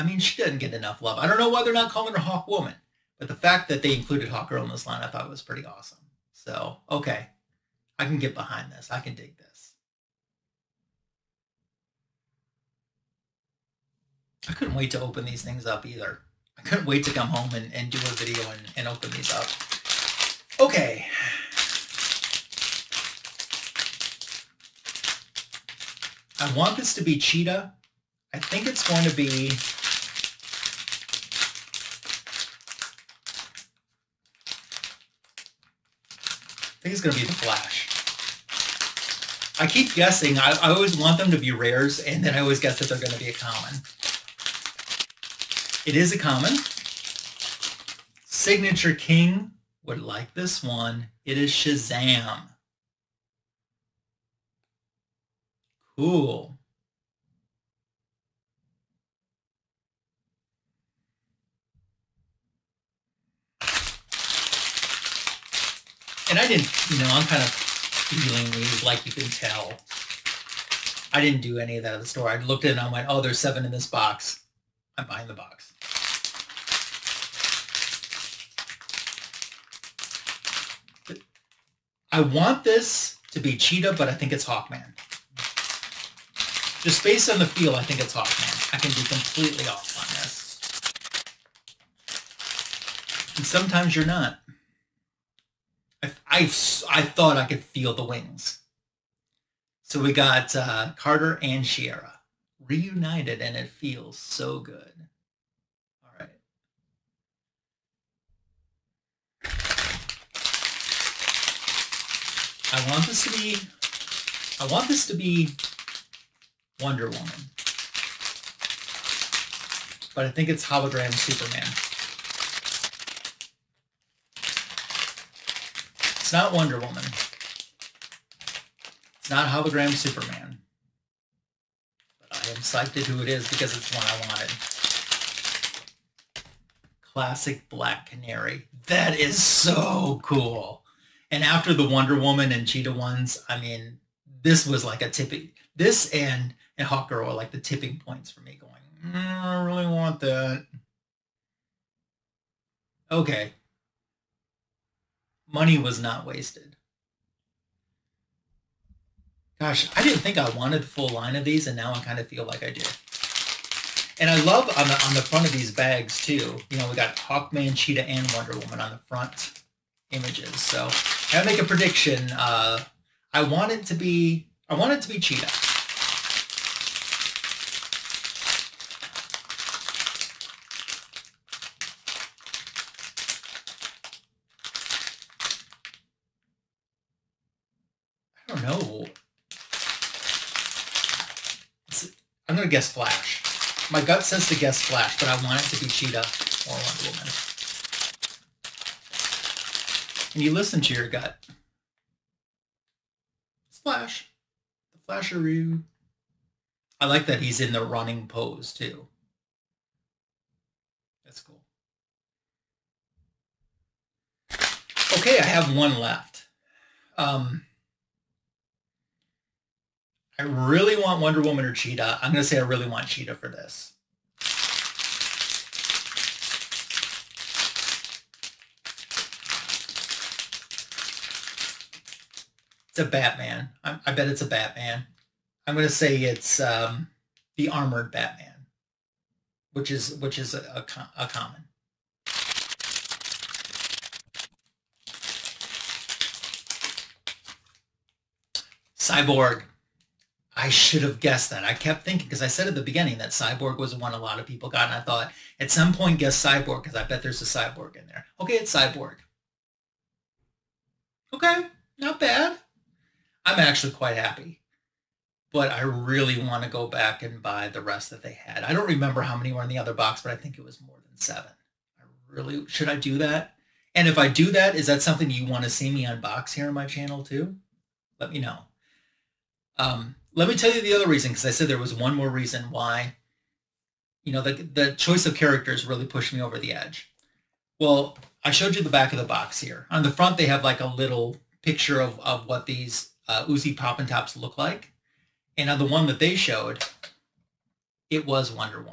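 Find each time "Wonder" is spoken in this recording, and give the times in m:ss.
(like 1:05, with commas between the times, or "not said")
1:56, 2:06, 2:21, 2:48, 3:16, 3:41.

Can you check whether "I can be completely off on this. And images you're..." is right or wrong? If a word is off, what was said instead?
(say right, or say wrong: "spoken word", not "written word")
wrong: "sometimes", not "images".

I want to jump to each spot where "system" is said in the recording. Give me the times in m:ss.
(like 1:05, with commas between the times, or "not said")
not said.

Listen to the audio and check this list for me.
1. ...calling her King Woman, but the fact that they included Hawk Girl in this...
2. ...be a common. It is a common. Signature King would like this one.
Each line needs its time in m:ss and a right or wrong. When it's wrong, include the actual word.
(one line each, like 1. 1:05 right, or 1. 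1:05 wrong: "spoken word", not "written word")
1. 0:01 wrong: "Hawk", not "King"
2. 0:43 right.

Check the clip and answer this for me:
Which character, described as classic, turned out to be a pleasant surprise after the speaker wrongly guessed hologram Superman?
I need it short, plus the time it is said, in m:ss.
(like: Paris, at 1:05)
Black Canary, at 2:17.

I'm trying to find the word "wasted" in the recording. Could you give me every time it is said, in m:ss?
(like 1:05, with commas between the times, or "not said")
2:36.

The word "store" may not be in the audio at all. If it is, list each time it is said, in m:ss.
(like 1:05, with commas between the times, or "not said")
1:12.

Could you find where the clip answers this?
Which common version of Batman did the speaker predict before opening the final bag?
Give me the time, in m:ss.
3:57.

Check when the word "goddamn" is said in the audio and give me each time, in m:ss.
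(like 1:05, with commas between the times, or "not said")
not said.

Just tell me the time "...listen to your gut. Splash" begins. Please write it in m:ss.
3:20.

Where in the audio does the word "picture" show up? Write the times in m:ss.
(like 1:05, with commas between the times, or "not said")
4:51.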